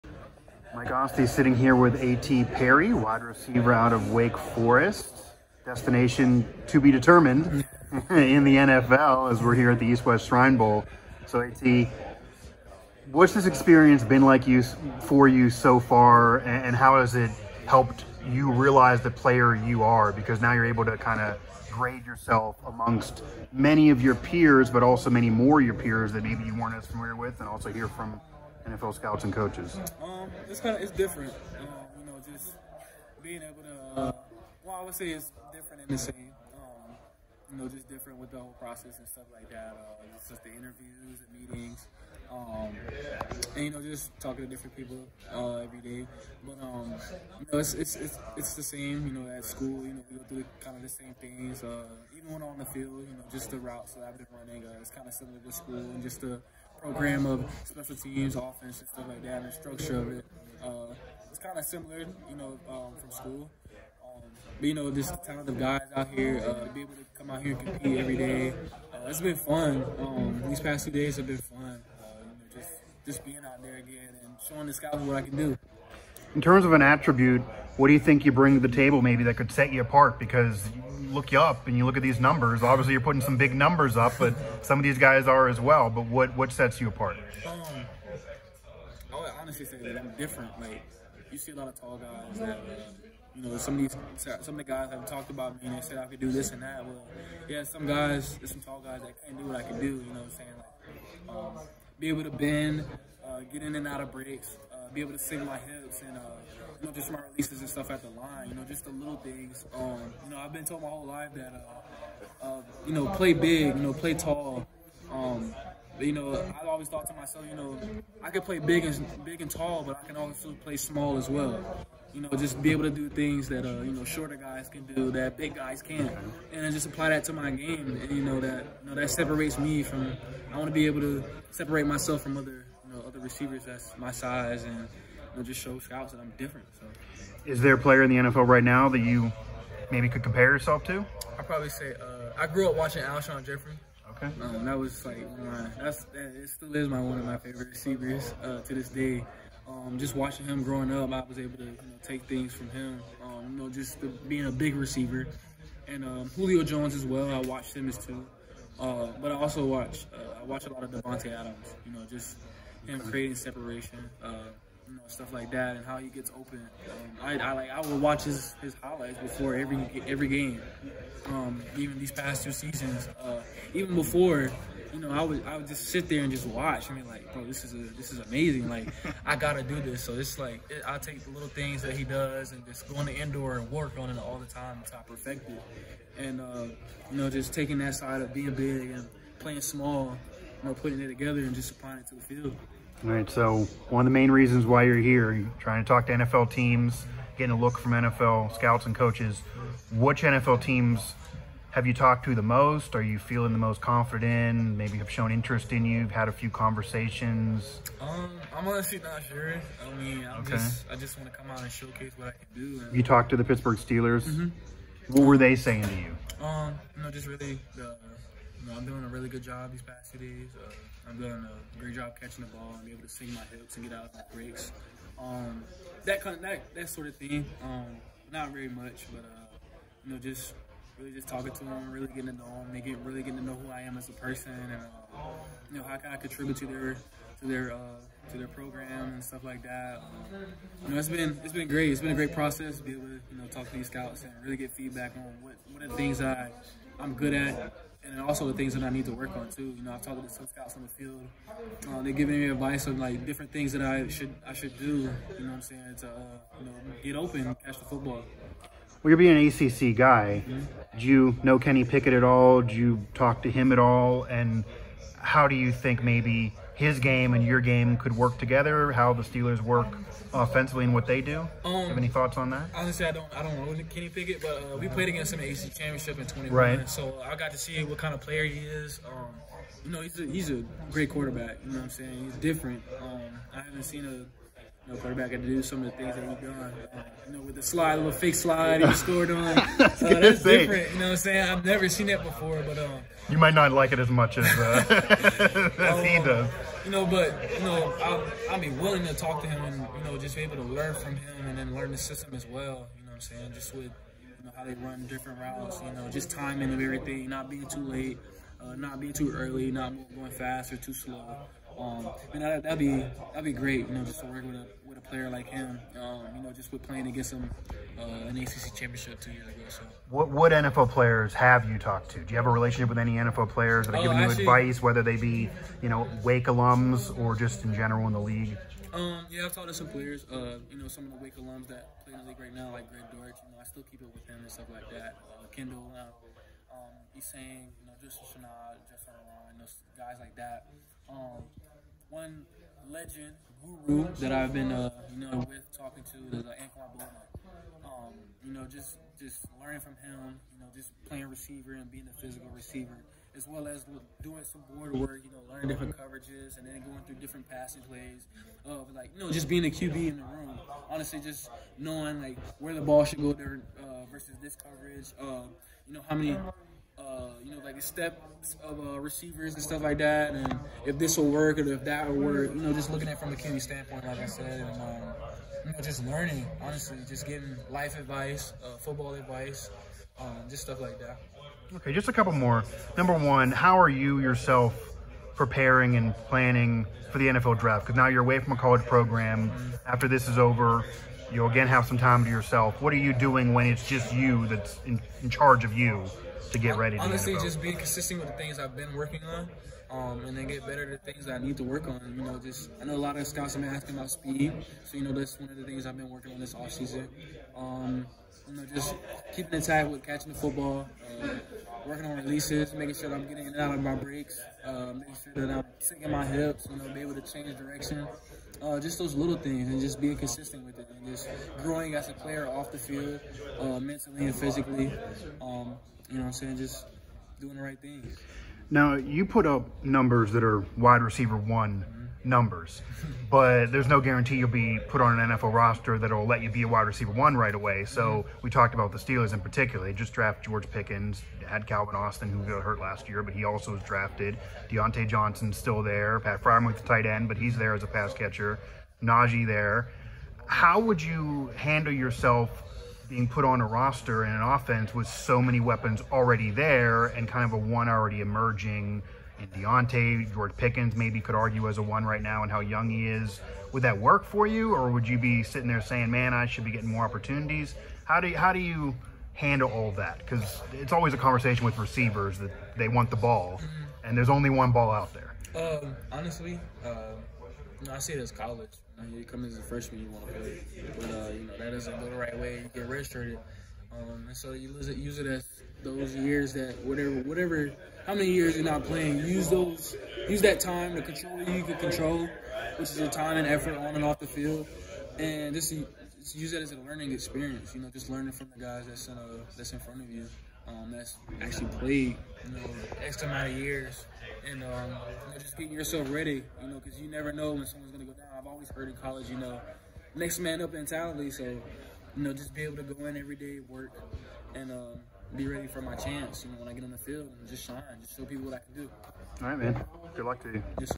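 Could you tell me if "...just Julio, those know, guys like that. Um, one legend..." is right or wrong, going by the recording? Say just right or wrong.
wrong.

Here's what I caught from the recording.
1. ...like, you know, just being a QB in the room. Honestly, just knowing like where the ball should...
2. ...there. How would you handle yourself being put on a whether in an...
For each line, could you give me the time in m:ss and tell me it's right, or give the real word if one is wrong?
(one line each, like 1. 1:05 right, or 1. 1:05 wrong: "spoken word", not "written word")
1. 5:58 right
2. 7:29 wrong: "roster", not "whether".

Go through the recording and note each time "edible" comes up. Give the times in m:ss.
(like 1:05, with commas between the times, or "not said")
not said.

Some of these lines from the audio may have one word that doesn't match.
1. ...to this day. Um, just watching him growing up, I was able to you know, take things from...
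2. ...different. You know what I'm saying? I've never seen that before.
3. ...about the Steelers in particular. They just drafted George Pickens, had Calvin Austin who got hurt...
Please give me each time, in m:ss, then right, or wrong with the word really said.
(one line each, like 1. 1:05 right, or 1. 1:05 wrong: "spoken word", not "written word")
1. 2:28 right
2. 4:50 right
3. 7:18 right.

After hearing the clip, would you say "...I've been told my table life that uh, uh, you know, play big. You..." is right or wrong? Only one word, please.
wrong.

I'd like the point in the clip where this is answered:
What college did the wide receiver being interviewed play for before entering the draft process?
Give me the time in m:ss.
0:04.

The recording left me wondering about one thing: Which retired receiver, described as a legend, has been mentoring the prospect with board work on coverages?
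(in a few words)
Anquan Boldin.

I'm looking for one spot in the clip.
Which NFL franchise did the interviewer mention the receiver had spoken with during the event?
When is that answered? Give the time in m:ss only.
3:33.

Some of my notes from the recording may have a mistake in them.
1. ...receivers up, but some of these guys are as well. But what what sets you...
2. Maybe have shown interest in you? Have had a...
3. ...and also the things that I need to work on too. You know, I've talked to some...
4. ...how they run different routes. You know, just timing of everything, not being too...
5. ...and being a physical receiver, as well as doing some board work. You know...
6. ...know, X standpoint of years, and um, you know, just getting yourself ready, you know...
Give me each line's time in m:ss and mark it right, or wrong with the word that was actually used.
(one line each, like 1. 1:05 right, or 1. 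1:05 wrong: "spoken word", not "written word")
1. 1:23 wrong: "numbers", not "receivers"
2. 3:24 right
3. 4:08 right
4. 5:04 right
5. 5:51 right
6. 8:22 wrong: "amount", not "standpoint".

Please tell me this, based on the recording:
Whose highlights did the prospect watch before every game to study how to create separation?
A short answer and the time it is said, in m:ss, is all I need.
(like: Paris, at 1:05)
Davante Adams, at 2:40.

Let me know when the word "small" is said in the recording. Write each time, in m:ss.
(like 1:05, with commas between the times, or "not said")
2:00, 3:09.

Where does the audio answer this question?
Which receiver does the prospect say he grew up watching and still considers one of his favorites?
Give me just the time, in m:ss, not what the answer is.
2:23.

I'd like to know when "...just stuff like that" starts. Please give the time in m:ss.
6:20.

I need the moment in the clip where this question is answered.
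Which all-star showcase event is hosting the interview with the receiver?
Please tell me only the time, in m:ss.
0:09.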